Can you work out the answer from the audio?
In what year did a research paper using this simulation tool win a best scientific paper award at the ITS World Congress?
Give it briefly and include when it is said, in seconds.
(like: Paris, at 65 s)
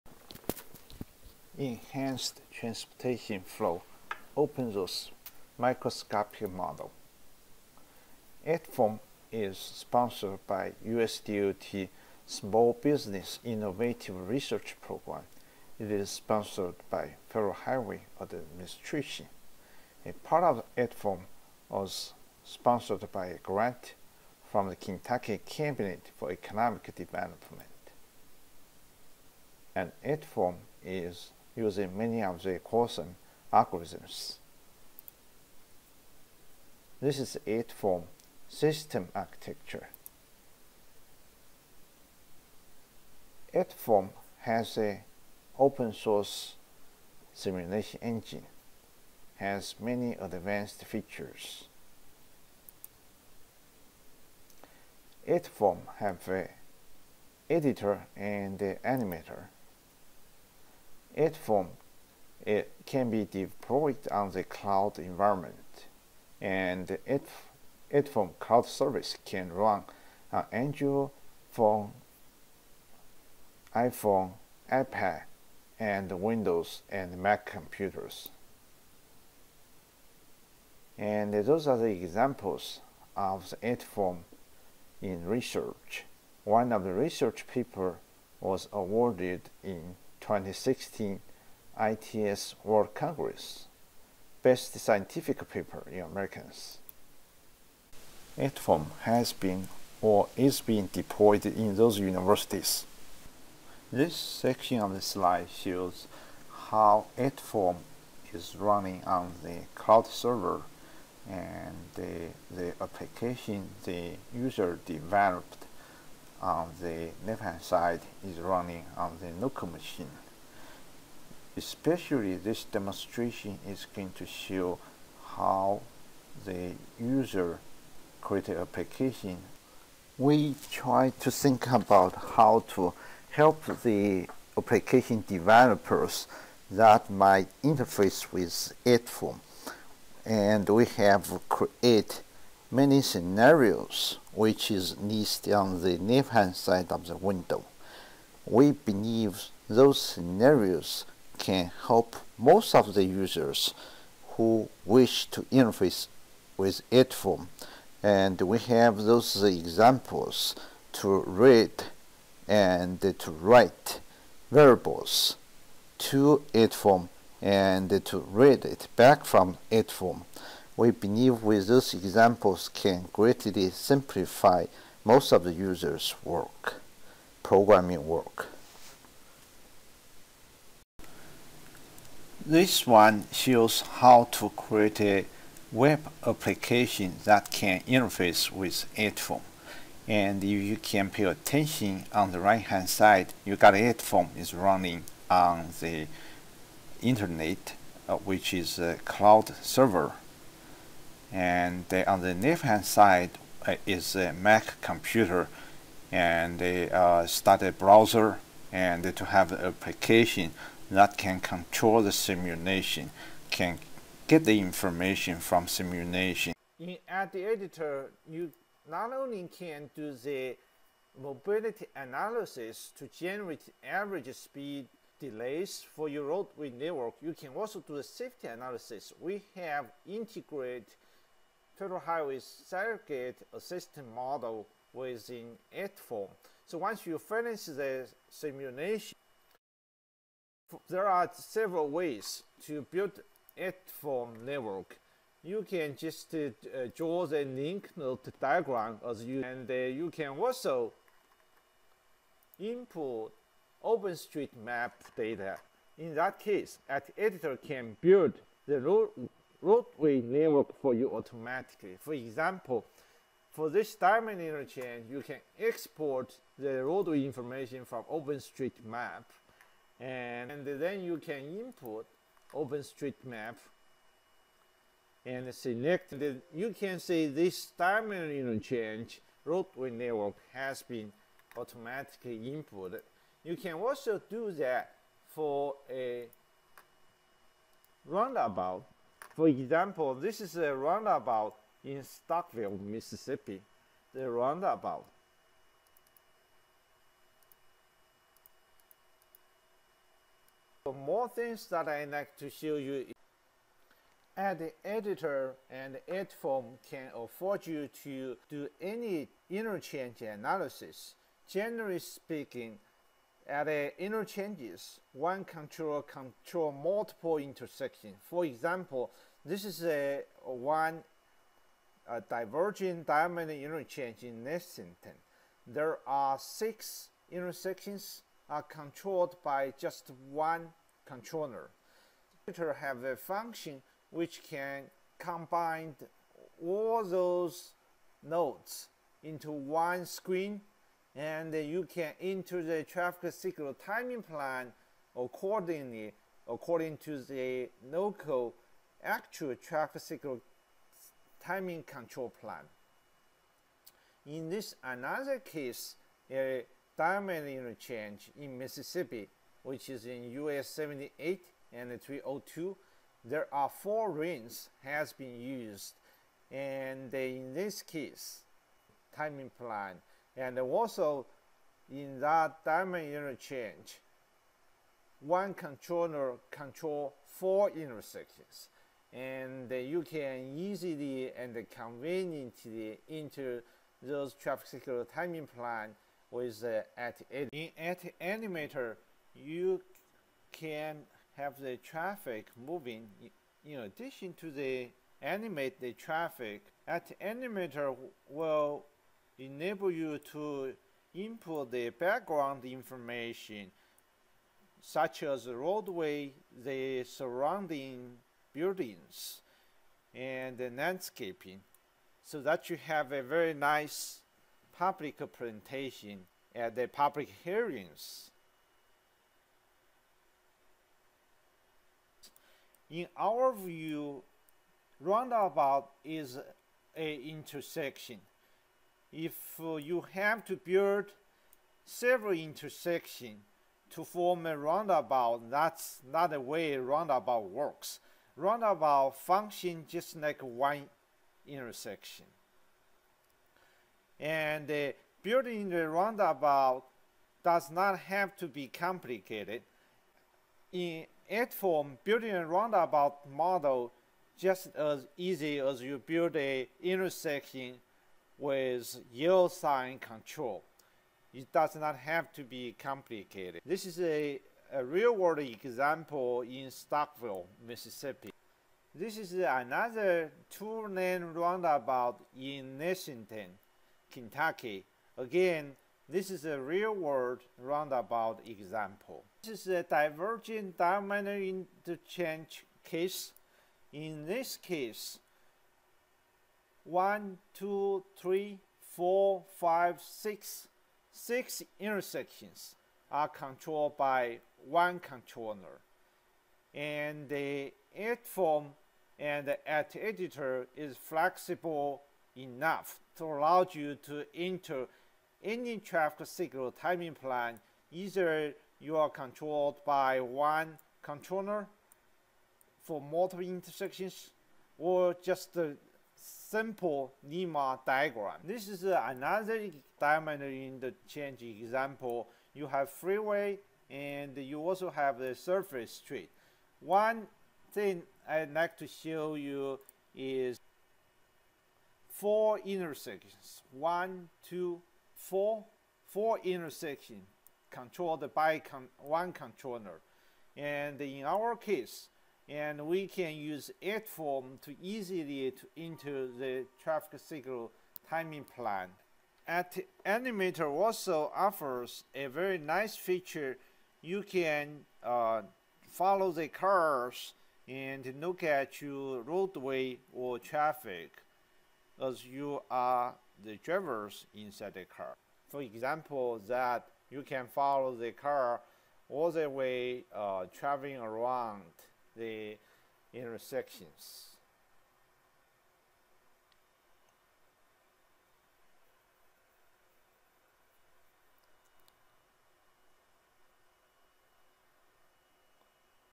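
2016, at 90 s.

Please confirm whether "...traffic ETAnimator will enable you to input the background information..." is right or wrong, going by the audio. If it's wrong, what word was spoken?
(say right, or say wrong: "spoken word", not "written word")
right.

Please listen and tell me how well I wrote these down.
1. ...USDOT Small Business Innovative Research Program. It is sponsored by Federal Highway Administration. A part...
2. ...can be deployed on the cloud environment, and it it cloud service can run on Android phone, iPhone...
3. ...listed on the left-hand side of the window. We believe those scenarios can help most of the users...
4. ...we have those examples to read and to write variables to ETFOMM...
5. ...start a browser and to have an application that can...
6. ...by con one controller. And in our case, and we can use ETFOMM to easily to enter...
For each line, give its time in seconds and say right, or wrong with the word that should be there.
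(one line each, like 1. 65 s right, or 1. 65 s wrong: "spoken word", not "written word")
1. 10 s right
2. 62 s right
3. 144 s right
4. 158 s right
5. 207 s right
6. 538 s right.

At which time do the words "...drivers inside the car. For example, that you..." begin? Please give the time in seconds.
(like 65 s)
563 s.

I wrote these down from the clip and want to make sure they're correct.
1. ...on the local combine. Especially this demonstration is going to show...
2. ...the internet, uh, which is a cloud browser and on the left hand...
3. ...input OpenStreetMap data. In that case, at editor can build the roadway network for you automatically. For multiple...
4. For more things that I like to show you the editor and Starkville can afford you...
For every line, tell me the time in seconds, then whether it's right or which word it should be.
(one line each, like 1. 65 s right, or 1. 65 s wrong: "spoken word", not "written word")
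1. 118 s wrong: "machine", not "combine"
2. 195 s wrong: "server", not "browser"
3. 252 s wrong: "example", not "multiple"
4. 300 s wrong: "ETFOMM", not "Starkville".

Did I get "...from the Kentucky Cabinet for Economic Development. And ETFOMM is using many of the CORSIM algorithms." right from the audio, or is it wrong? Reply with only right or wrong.
right.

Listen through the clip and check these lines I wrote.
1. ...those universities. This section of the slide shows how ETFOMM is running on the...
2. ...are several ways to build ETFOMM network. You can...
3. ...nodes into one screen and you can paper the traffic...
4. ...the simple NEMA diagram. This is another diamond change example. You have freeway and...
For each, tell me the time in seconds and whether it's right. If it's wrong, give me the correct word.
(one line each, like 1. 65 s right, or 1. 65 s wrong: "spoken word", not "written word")
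1. 101 s right
2. 241 s right
3. 338 s wrong: "enter", not "paper"
4. 515 s right.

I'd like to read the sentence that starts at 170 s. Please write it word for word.
We believe with these examples can greatly simplify most of the user's work, programming work.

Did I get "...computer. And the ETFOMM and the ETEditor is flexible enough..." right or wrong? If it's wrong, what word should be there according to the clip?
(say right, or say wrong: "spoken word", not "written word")
wrong: "controller", not "computer".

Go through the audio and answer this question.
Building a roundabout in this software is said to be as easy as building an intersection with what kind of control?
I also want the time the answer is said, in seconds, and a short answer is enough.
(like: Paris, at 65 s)
Yield sign control, at 459 s.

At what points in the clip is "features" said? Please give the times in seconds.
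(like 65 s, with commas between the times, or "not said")
50 s, 552 s.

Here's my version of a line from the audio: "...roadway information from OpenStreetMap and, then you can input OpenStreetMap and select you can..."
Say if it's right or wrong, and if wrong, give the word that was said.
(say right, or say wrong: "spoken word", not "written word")
right.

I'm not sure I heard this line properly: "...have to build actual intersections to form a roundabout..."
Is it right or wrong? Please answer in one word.
wrong.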